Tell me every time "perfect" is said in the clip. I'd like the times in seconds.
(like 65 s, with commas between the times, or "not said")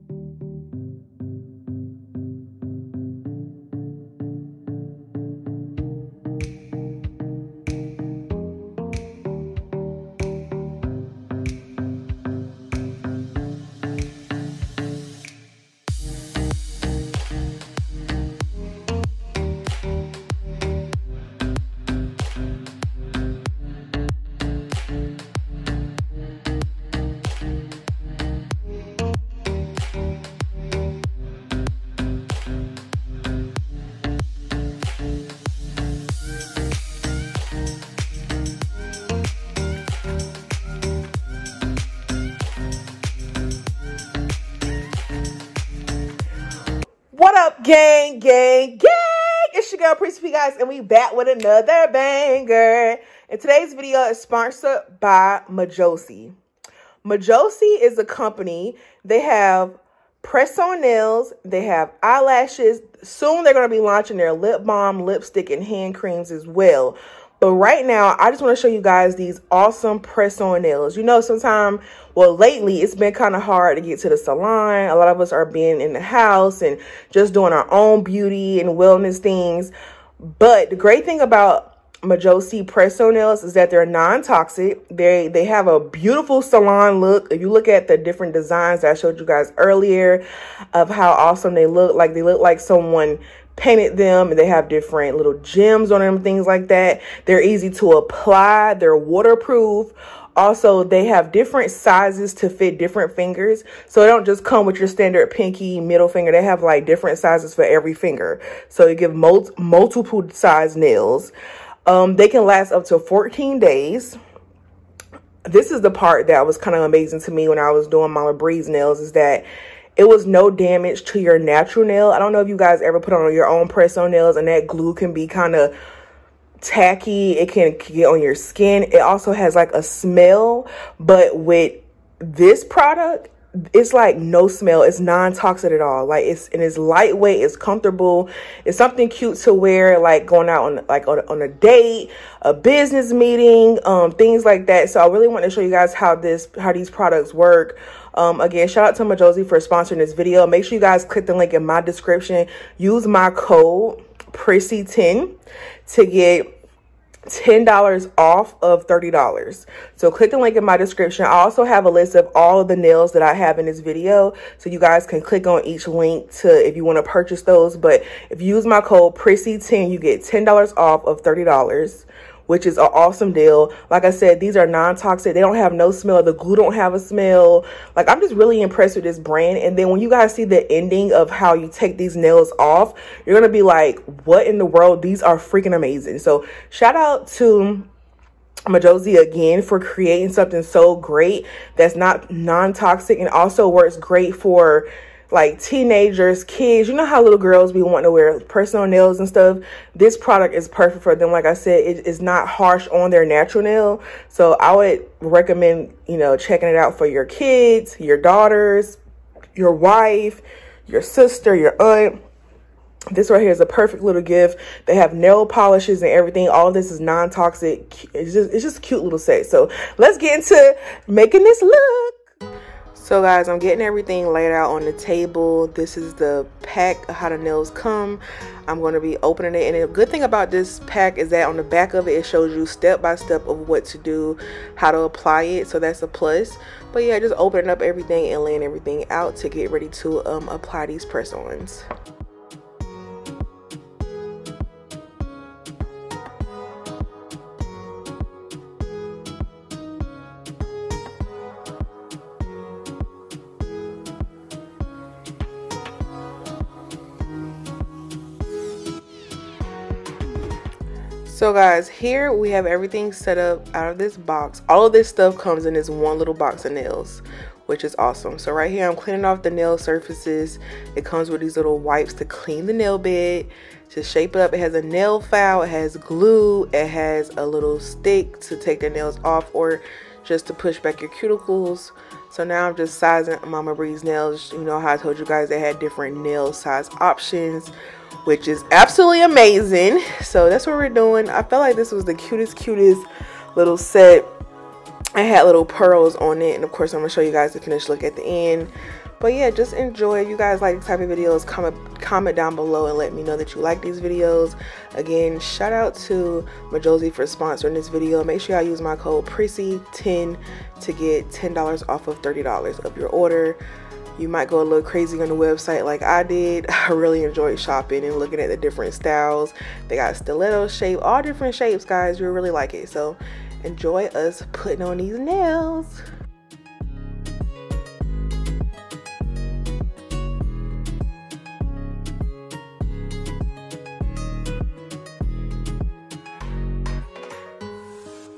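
200 s, 213 s.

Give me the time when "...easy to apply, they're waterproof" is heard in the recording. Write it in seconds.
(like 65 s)
97 s.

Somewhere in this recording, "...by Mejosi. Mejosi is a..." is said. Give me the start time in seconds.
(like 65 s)
54 s.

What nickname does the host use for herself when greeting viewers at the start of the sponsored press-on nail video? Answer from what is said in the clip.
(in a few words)
Prissy P.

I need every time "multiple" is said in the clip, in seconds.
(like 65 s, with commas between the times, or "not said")
109 s.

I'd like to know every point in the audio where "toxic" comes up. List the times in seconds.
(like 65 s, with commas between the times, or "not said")
83 s, 135 s, 174 s, 192 s, 217 s.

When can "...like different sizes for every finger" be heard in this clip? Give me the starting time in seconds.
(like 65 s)
106 s.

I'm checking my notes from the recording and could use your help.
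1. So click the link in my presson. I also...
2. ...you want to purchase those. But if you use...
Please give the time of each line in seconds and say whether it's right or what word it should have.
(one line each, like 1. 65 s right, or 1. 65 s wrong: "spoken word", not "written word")
1. 159 s wrong: "description", not "presson"
2. 166 s right.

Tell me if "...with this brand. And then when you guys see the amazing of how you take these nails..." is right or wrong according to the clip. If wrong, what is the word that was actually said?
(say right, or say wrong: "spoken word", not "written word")
wrong: "ending", not "amazing".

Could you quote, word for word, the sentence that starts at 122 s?
I don't know if you guys ever put on your own press on nails and that glue can be kind of tacky.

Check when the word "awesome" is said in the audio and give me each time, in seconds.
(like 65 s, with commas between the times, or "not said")
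69 s, 91 s, 172 s, 267 s.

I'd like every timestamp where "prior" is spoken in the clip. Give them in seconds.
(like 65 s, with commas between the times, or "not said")
not said.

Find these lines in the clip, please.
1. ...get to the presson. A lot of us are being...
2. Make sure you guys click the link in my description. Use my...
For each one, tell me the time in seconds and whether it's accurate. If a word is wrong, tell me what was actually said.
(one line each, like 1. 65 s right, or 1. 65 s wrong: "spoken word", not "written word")
1. 73 s wrong: "salon", not "presson"
2. 150 s right.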